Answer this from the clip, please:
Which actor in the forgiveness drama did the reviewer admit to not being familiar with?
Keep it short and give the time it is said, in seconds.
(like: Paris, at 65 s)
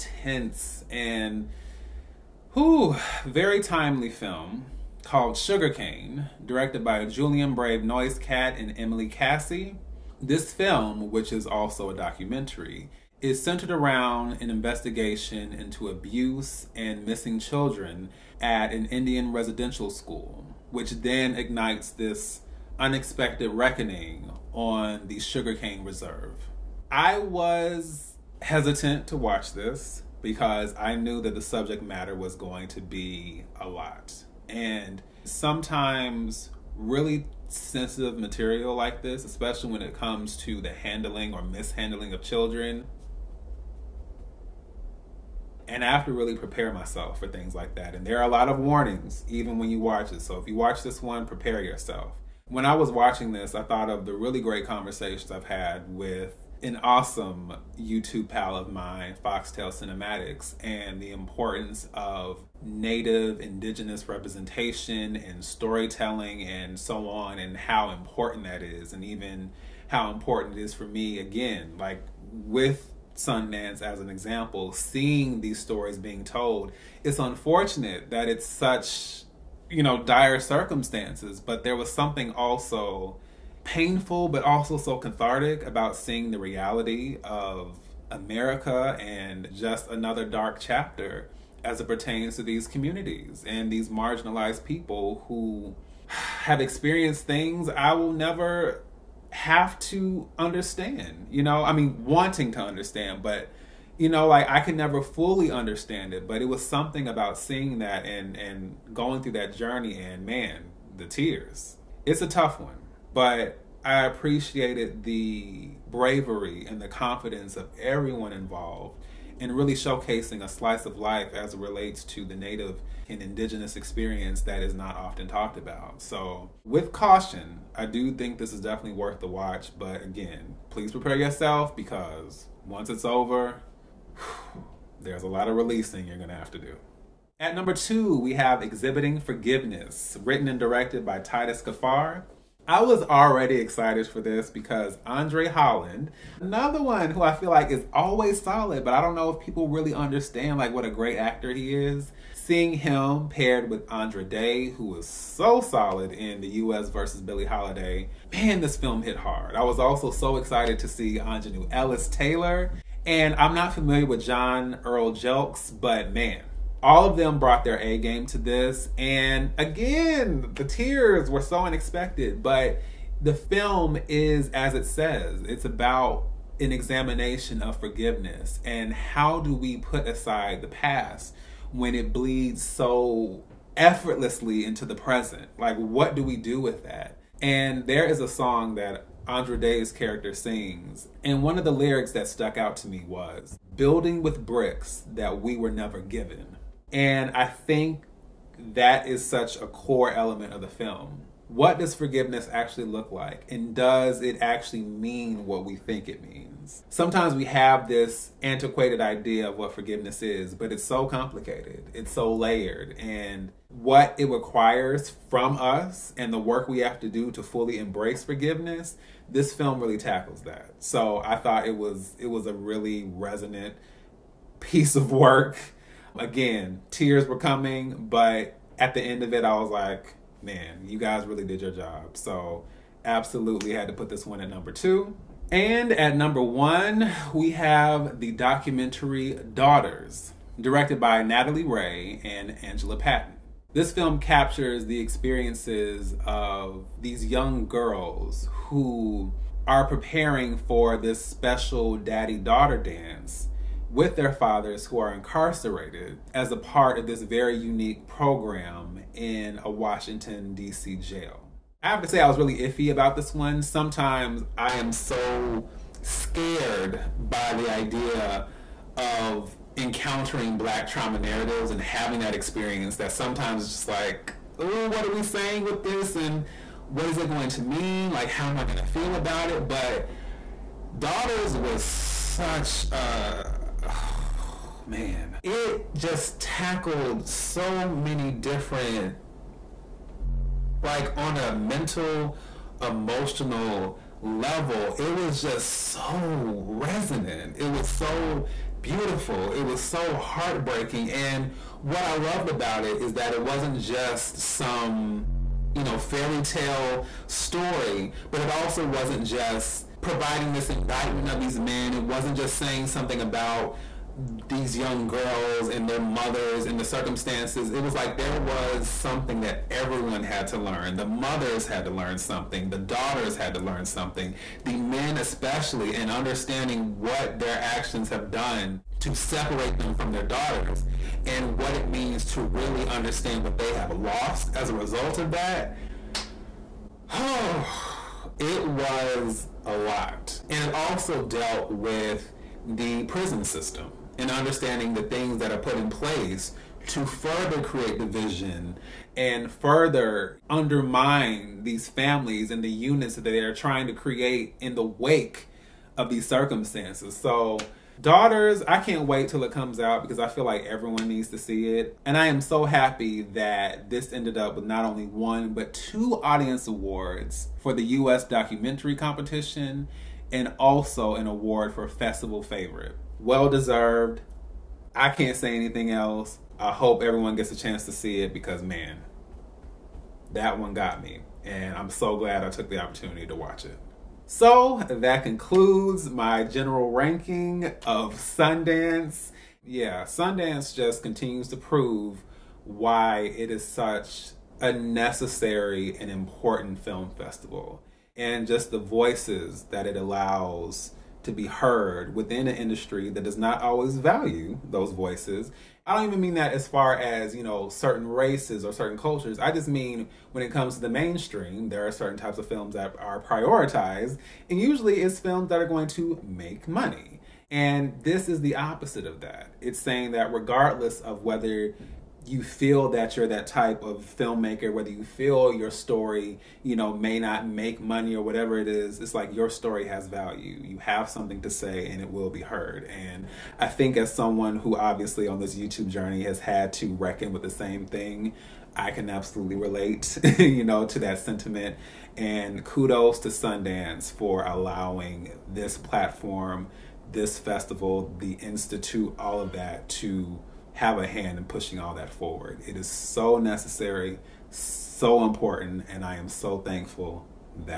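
John Earl Jelks, at 164 s.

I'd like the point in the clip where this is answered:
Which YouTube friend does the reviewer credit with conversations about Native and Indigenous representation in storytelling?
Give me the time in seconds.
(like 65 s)
59 s.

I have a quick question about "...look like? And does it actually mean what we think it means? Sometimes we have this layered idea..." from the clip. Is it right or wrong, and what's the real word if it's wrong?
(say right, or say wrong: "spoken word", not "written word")
wrong: "antiquated", not "layered".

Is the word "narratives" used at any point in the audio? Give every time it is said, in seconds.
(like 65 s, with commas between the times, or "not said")
271 s.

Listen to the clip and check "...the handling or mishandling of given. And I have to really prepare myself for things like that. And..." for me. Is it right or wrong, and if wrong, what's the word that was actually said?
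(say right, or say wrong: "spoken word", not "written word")
wrong: "children", not "given".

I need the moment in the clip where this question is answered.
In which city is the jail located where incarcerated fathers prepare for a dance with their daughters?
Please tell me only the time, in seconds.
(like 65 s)
259 s.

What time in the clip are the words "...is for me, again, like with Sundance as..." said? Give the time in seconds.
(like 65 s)
70 s.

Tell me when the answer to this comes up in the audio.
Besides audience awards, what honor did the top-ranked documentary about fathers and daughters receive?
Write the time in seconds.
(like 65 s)
371 s.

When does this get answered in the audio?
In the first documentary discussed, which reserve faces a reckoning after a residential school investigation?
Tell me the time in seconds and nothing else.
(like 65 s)
25 s.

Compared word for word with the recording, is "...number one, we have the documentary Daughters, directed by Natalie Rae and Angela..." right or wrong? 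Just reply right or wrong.
right.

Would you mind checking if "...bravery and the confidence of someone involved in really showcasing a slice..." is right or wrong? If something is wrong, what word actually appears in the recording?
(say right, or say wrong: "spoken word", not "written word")
wrong: "everyone", not "someone".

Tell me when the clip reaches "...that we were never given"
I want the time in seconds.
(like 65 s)
195 s.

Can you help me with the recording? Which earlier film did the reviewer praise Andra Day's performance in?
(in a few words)
The U.S. versus Billie Holiday.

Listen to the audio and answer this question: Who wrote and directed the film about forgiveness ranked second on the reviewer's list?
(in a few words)
Titus Kaphar.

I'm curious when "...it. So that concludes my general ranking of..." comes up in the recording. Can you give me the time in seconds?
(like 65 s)
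383 s.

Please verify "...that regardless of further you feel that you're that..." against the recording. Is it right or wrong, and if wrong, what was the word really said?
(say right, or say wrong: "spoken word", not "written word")
wrong: "whether", not "further".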